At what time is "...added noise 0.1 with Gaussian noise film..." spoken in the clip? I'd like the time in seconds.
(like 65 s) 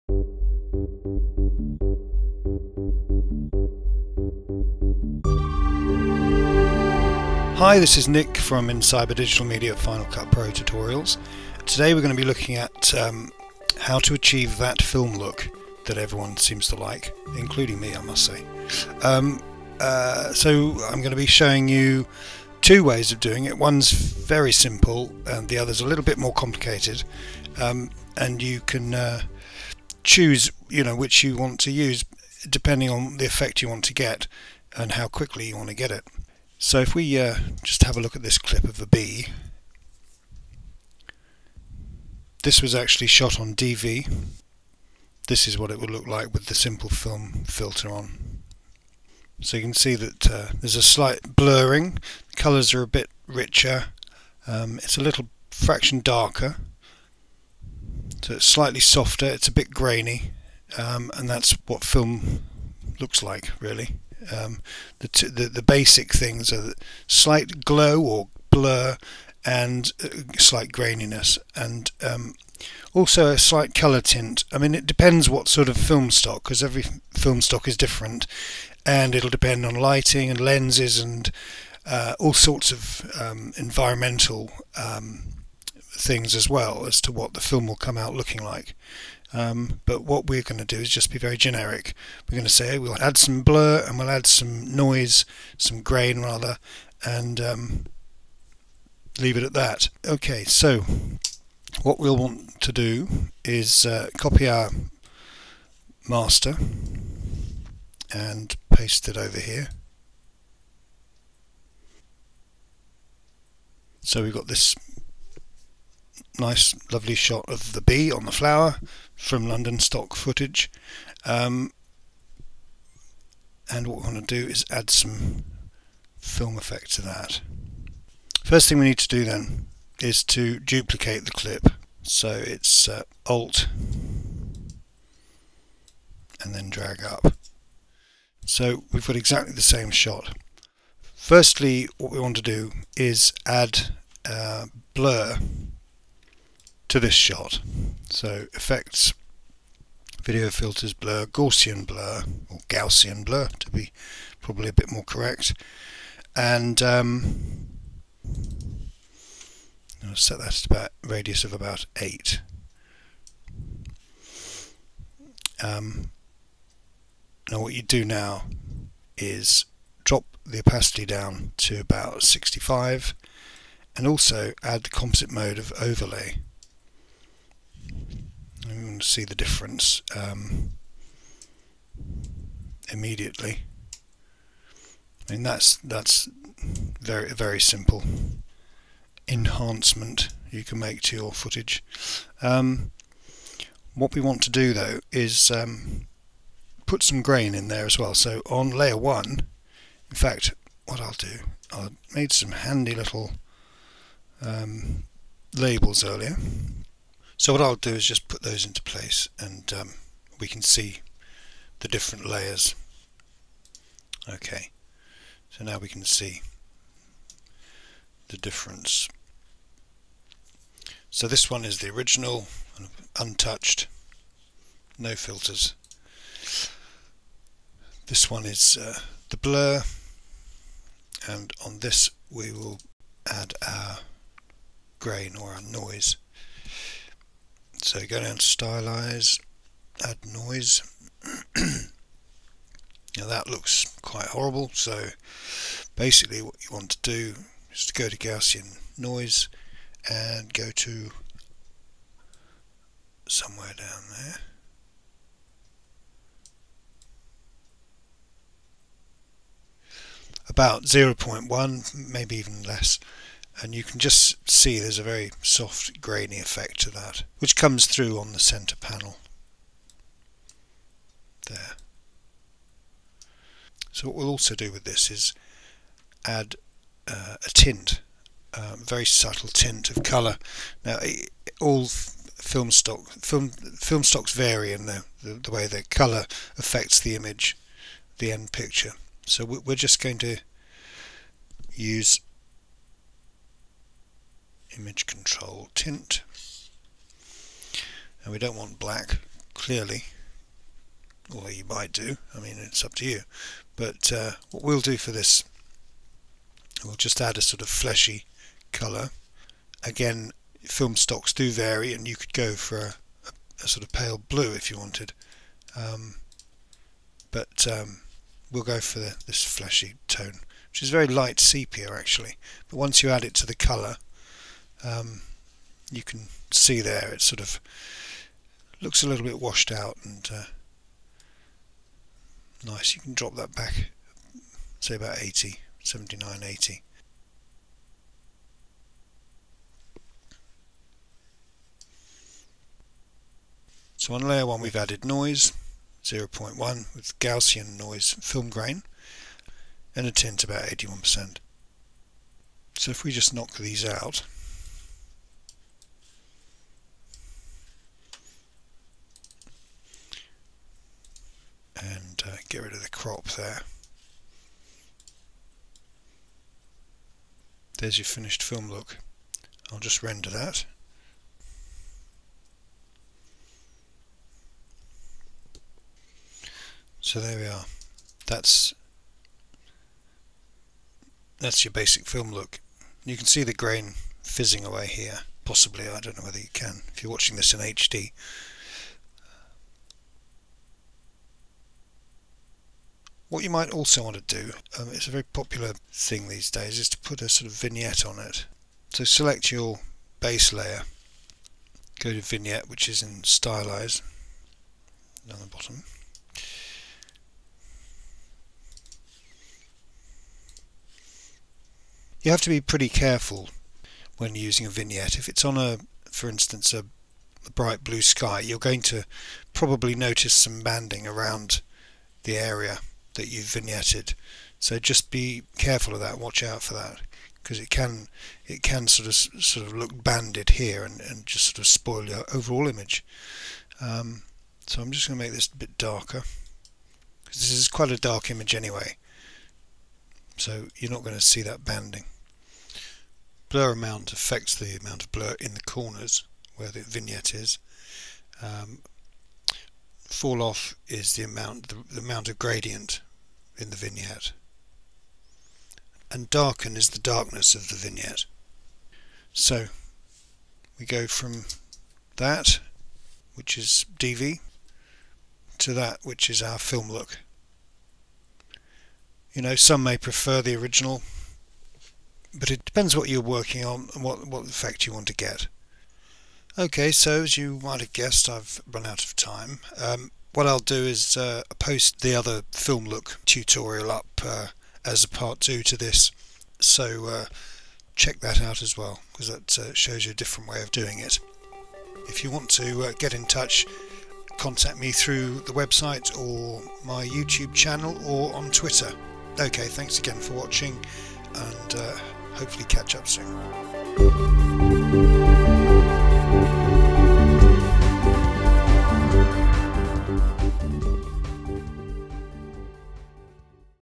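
344 s.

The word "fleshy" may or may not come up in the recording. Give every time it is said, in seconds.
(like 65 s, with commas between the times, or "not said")
307 s, 319 s.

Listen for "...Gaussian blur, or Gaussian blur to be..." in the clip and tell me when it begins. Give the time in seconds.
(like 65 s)
151 s.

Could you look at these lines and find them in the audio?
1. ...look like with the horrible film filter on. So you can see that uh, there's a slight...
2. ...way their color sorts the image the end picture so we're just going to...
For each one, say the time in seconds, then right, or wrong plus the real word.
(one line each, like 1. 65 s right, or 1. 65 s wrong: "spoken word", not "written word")
1. 45 s wrong: "simple", not "horrible"
2. 285 s wrong: "affects", not "sorts".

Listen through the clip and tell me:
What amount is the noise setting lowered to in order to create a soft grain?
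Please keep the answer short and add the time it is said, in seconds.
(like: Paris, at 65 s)
0.1, at 260 s.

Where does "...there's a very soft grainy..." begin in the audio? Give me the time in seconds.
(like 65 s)
264 s.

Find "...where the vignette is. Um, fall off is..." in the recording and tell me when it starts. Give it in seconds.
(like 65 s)
446 s.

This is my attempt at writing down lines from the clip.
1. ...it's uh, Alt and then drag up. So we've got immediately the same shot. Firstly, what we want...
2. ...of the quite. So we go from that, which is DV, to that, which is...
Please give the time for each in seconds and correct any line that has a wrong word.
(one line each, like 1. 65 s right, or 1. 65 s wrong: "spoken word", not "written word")
1. 132 s wrong: "exactly", not "immediately"
2. 457 s wrong: "vignette", not "quite".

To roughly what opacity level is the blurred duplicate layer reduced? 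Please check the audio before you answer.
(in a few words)
65.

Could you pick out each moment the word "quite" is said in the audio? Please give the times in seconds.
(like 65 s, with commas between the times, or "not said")
244 s, 437 s.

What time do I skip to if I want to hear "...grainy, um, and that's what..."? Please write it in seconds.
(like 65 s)
59 s.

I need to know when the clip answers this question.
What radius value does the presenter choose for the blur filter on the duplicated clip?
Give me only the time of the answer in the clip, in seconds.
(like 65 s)
161 s.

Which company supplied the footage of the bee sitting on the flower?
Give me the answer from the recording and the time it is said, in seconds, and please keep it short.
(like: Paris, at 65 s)
London stock footage, at 119 s.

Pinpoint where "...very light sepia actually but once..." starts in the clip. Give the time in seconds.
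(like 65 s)
320 s.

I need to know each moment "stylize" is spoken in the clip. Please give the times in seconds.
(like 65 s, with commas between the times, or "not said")
238 s, 403 s.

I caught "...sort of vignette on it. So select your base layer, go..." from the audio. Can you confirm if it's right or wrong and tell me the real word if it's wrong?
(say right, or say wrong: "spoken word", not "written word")
right.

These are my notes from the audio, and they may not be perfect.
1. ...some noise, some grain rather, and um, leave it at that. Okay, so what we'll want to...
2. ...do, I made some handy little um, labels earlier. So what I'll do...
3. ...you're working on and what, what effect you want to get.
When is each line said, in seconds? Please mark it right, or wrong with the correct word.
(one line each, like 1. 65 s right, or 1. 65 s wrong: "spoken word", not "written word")
1. 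94 s right
2. 201 s right
3. 473 s right.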